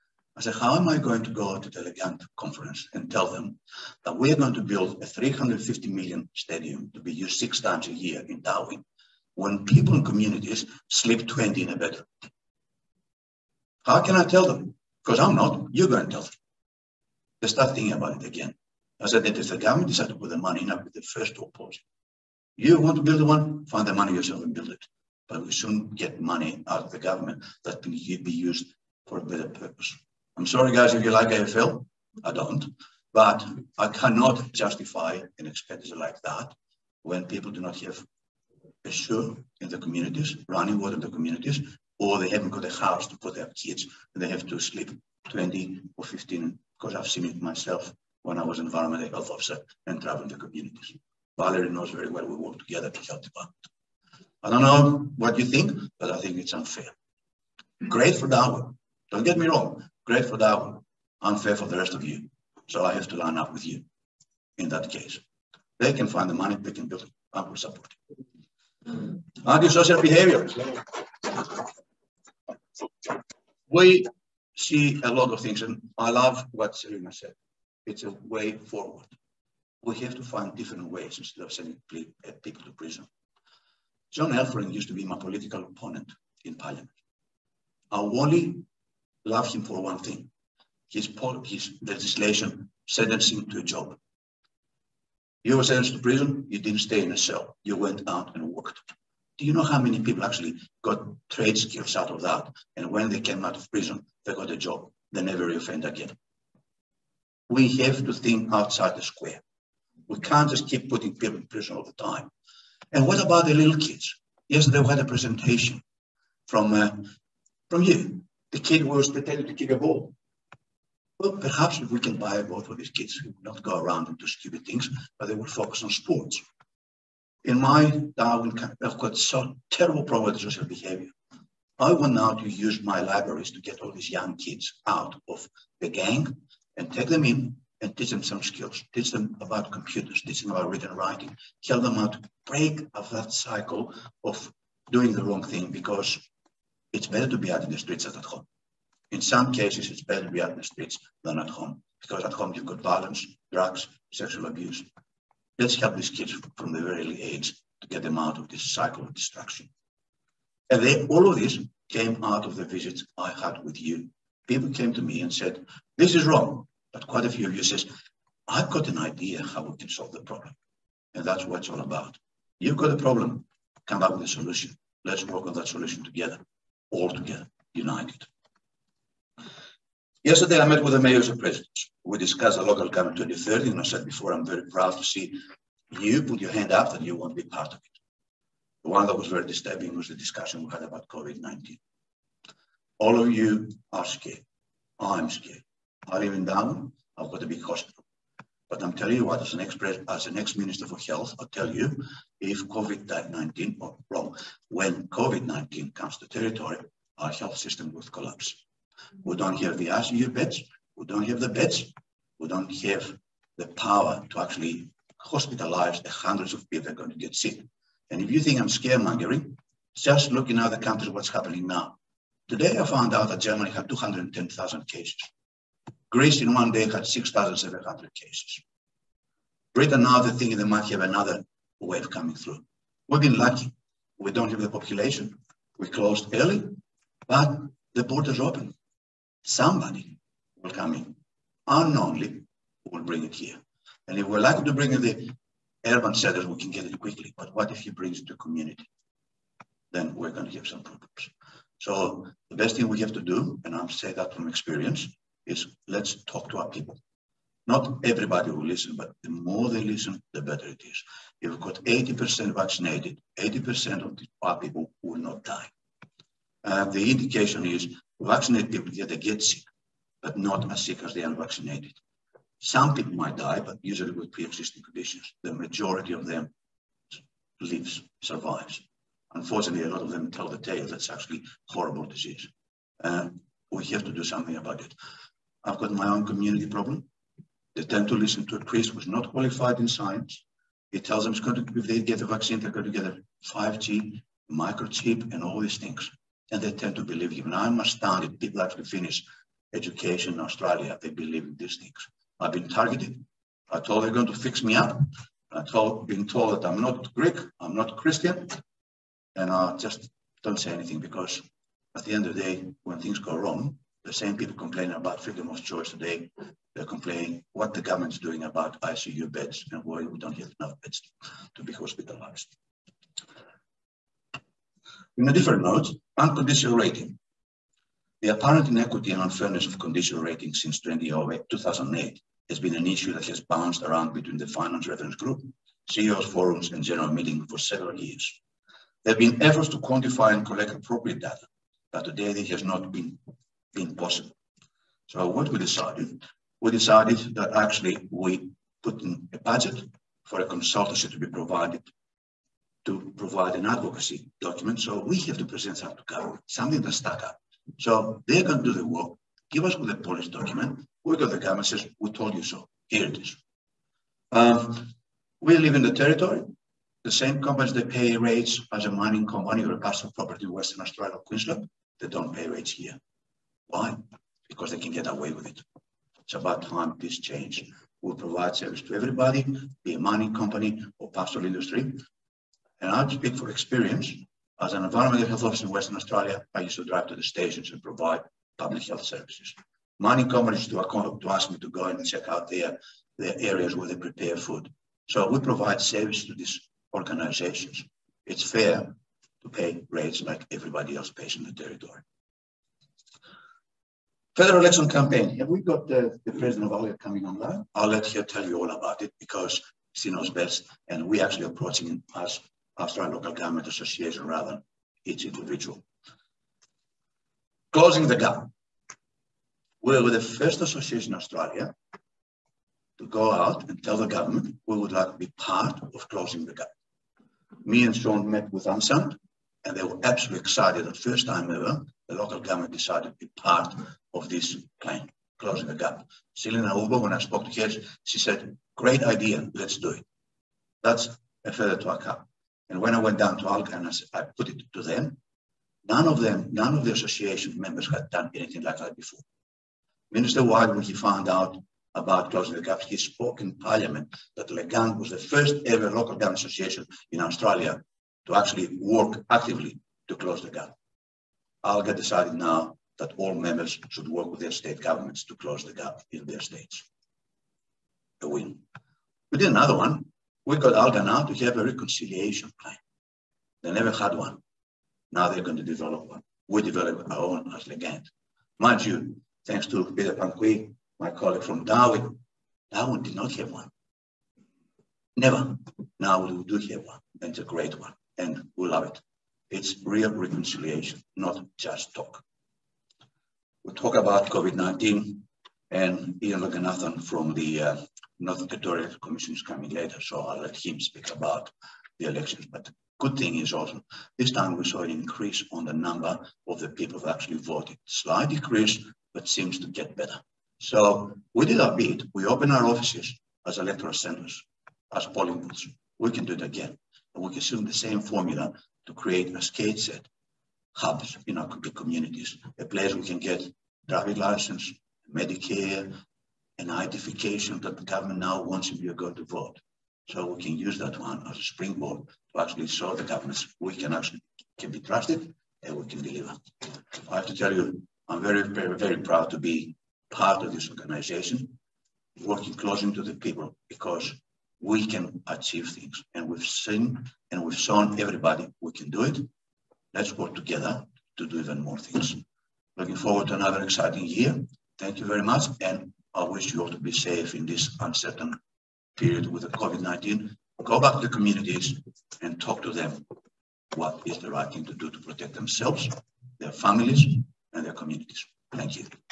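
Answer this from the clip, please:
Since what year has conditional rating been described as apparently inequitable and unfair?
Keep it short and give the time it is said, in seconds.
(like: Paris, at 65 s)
2008, at 330 s.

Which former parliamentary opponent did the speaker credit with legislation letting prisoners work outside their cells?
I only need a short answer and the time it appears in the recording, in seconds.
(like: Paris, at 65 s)
John Elferink, at 84 s.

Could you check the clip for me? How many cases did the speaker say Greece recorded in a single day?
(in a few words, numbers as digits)
6,700.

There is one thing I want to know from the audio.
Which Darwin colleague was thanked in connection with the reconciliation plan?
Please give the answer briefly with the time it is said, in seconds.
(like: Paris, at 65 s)
Peter Pangquee, at 479 s.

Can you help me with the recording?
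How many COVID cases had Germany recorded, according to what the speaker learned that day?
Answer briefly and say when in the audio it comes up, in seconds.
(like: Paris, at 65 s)
210,000, at 223 s.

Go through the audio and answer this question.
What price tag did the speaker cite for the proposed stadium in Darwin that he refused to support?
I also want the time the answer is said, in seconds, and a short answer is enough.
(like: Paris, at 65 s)
350 million, at 5 s.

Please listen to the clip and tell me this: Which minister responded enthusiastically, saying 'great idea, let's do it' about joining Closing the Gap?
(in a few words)
Selena Uibo.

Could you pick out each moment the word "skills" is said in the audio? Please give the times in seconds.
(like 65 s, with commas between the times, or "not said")
101 s, 138 s.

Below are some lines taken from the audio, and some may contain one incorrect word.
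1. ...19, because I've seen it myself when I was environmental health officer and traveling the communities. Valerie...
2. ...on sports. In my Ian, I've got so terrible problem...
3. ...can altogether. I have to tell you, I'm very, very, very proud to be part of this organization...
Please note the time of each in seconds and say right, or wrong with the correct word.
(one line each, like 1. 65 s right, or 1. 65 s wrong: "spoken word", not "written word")
1. 46 s wrong: "15", not "19"
2. 125 s wrong: "Darwin", not "Ian"
3. 535 s wrong: "deliver", not "altogether".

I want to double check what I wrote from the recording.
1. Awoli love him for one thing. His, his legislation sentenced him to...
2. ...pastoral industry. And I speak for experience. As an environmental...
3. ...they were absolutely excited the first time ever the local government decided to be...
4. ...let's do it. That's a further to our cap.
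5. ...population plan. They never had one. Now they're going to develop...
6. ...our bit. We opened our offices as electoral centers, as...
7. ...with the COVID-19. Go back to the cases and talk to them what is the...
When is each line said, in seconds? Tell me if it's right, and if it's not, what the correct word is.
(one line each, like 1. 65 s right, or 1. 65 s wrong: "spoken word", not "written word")
1. 87 s right
2. 381 s right
3. 429 s right
4. 439 s right
5. 471 s wrong: "reconciliation", not "population"
6. 511 s right
7. 559 s wrong: "communities", not "cases".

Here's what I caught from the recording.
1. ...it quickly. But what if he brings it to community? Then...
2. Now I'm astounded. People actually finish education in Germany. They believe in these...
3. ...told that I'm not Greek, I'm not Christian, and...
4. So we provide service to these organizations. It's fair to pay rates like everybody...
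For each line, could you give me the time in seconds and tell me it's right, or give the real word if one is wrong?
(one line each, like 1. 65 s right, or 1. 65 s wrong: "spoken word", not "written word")
1. 246 s right
2. 297 s wrong: "Australia", not "Germany"
3. 306 s right
4. 395 s right.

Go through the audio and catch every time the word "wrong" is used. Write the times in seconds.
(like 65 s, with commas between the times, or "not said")
59 s, 145 s, 166 s, 204 s, 313 s.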